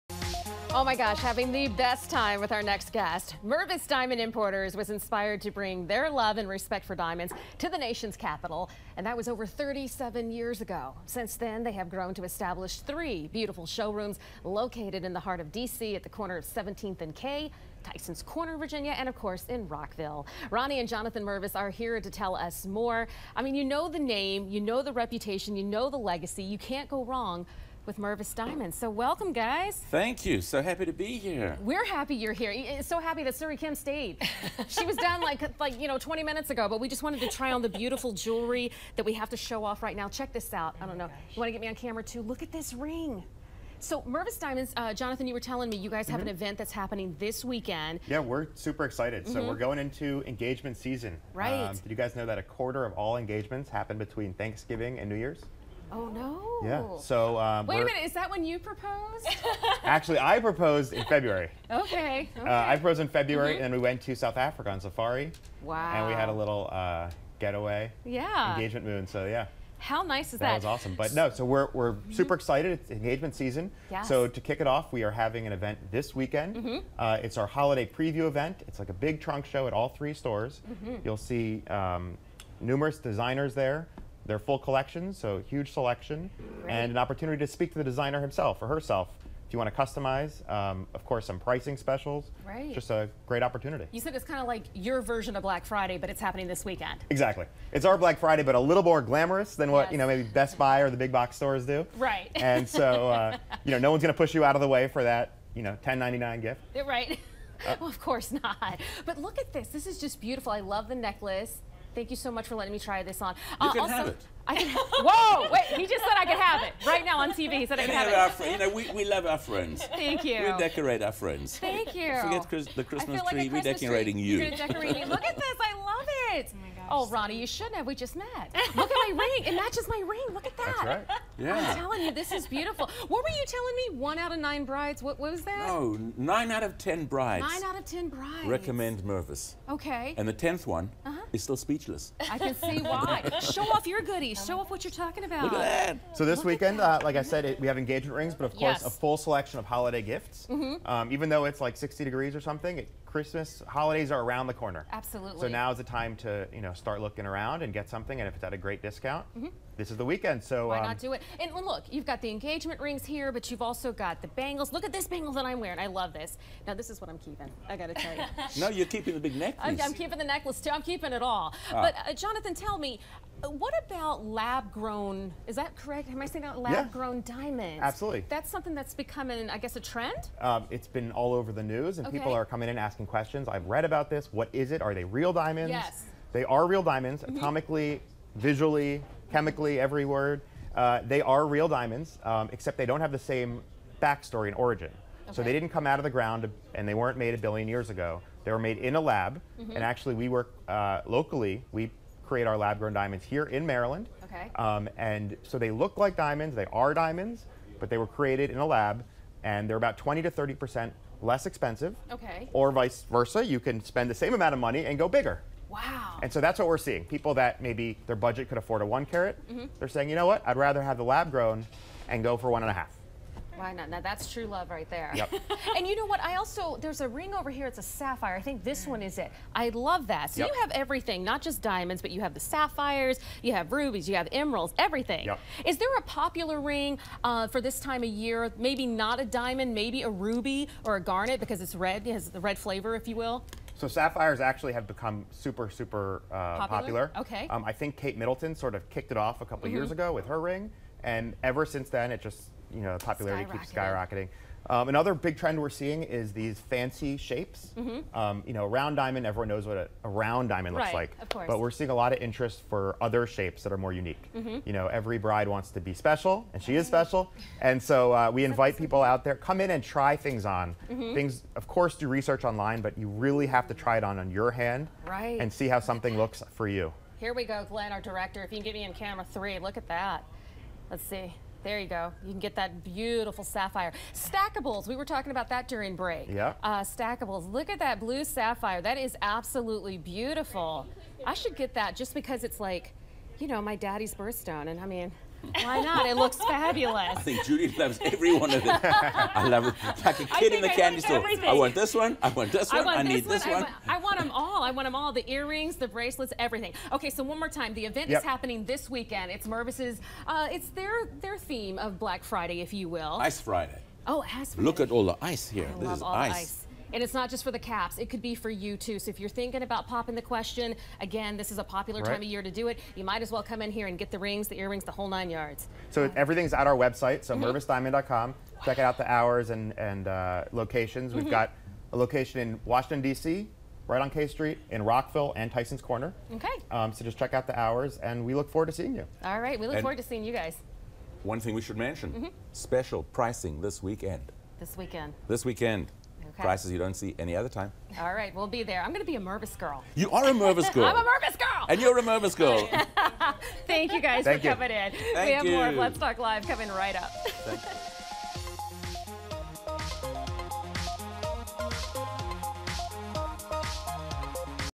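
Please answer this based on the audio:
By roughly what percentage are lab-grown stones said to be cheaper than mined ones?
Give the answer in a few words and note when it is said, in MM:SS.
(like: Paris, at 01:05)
20 to 30 percent, at 03:29.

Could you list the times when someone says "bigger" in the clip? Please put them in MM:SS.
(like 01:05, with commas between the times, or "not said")
03:35.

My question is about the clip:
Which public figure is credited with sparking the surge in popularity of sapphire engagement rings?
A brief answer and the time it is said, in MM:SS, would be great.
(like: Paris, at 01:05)
Kate Middleton, at 04:07.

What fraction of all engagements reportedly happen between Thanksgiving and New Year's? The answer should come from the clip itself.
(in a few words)
A quarter.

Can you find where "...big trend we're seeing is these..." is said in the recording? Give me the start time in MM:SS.
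04:15.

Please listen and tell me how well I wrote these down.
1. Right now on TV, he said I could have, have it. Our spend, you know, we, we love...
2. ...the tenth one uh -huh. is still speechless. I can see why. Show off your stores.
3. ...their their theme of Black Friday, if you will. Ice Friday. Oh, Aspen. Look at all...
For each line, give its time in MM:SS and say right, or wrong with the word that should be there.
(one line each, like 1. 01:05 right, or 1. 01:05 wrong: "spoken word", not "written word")
1. 01:56 wrong: "friend", not "spend"
2. 02:20 wrong: "goodies", not "stores"
3. 05:10 right.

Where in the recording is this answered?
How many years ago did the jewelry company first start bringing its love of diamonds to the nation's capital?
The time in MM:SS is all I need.
00:09.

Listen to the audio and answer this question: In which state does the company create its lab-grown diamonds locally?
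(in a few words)
Maryland.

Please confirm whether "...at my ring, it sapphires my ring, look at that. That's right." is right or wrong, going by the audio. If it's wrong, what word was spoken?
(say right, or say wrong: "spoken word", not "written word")
wrong: "matches", not "sapphires".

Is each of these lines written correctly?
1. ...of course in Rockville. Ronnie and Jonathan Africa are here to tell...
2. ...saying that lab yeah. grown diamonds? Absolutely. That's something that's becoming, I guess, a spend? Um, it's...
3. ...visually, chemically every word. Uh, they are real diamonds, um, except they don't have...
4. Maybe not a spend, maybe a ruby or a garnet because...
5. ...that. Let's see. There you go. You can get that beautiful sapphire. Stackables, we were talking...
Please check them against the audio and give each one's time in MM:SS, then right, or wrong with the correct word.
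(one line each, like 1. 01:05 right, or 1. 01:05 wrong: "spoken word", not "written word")
1. 00:19 wrong: "Mervis", not "Africa"
2. 02:56 wrong: "trend", not "spend"
3. 03:08 right
4. 03:58 wrong: "diamond", not "spend"
5. 04:39 right.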